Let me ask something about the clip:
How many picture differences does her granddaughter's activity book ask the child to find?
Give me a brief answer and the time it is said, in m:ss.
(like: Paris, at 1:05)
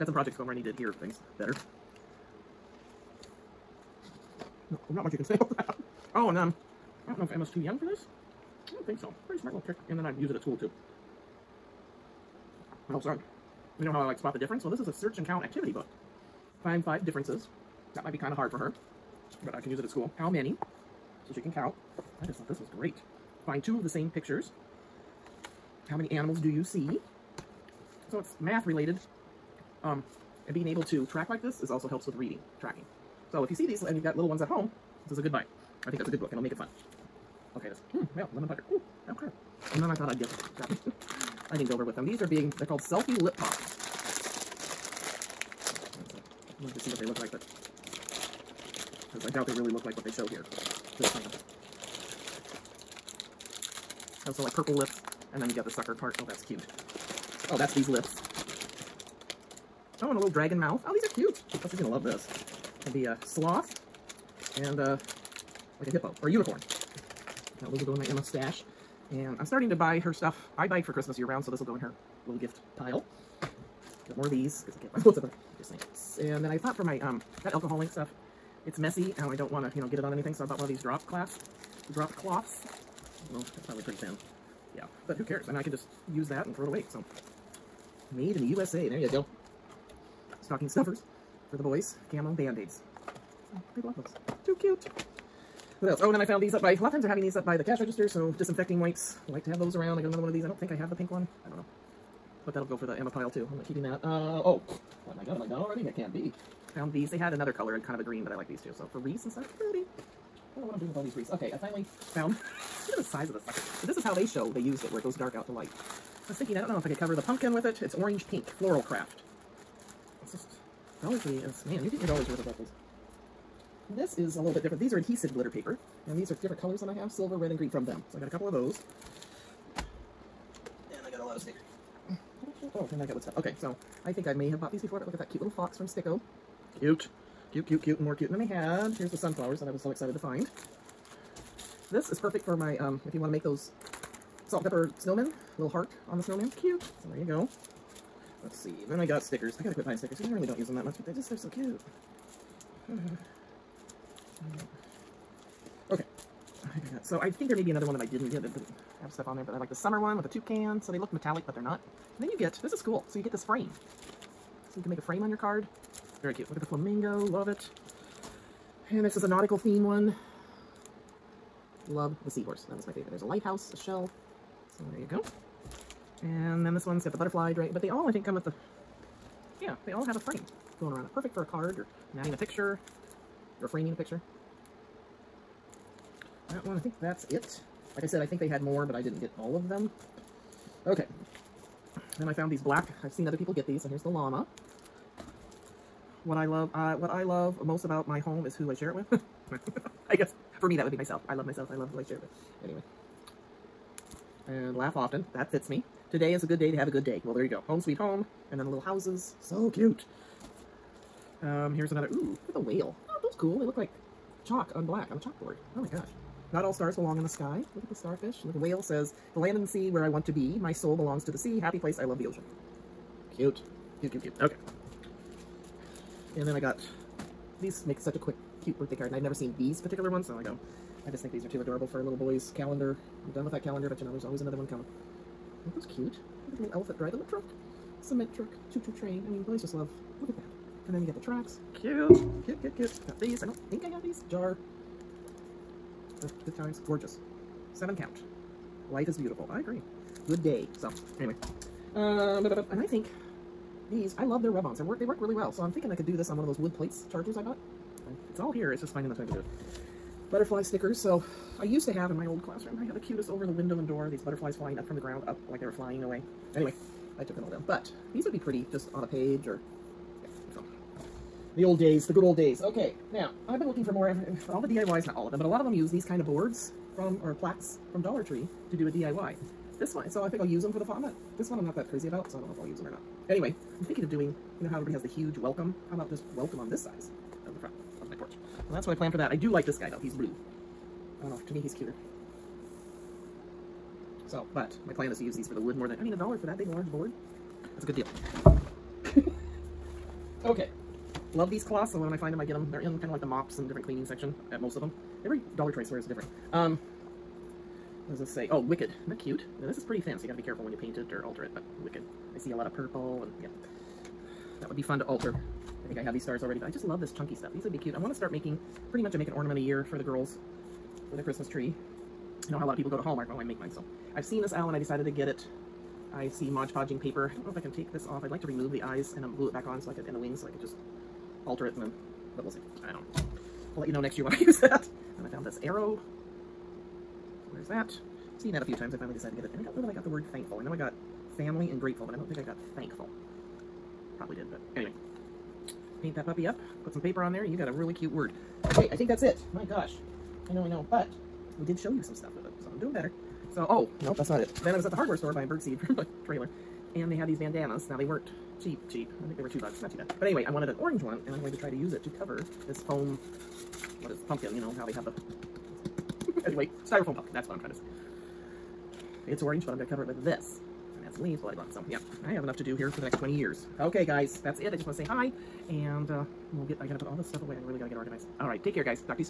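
5, at 0:16.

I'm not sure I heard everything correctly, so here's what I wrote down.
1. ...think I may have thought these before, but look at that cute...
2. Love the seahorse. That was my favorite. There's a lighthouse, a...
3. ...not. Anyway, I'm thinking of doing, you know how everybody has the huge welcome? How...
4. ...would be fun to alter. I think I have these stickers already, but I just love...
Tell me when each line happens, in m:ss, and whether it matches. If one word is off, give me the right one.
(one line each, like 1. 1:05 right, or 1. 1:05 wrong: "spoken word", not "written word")
1. 2:14 wrong: "bought", not "thought"
2. 2:51 right
3. 4:42 right
4. 5:14 wrong: "stars", not "stickers".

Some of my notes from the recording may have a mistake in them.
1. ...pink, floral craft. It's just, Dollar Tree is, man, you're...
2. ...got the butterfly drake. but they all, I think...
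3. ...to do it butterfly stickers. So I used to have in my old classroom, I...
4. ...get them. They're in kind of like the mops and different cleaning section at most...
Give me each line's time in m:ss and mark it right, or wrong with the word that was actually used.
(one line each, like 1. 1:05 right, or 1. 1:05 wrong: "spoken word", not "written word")
1. 1:58 right
2. 2:57 right
3. 4:19 right
4. 5:02 right.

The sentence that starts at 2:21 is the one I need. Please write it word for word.
This is perfect for my, um, if you want to make those salt and pepper snowmen, little heart on the snowman.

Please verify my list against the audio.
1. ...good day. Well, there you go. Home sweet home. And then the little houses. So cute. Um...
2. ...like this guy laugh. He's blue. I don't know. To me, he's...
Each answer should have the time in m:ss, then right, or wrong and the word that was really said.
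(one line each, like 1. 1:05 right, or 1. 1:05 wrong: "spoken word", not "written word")
1. 3:26 right
2. 4:49 wrong: "though", not "laugh".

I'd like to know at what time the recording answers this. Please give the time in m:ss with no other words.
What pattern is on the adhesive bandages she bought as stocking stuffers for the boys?
1:32.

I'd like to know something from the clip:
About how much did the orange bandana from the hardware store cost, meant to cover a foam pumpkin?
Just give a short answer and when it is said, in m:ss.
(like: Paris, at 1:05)
2 dollars, at 5:59.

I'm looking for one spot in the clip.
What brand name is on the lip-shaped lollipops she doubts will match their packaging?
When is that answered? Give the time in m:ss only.
0:42.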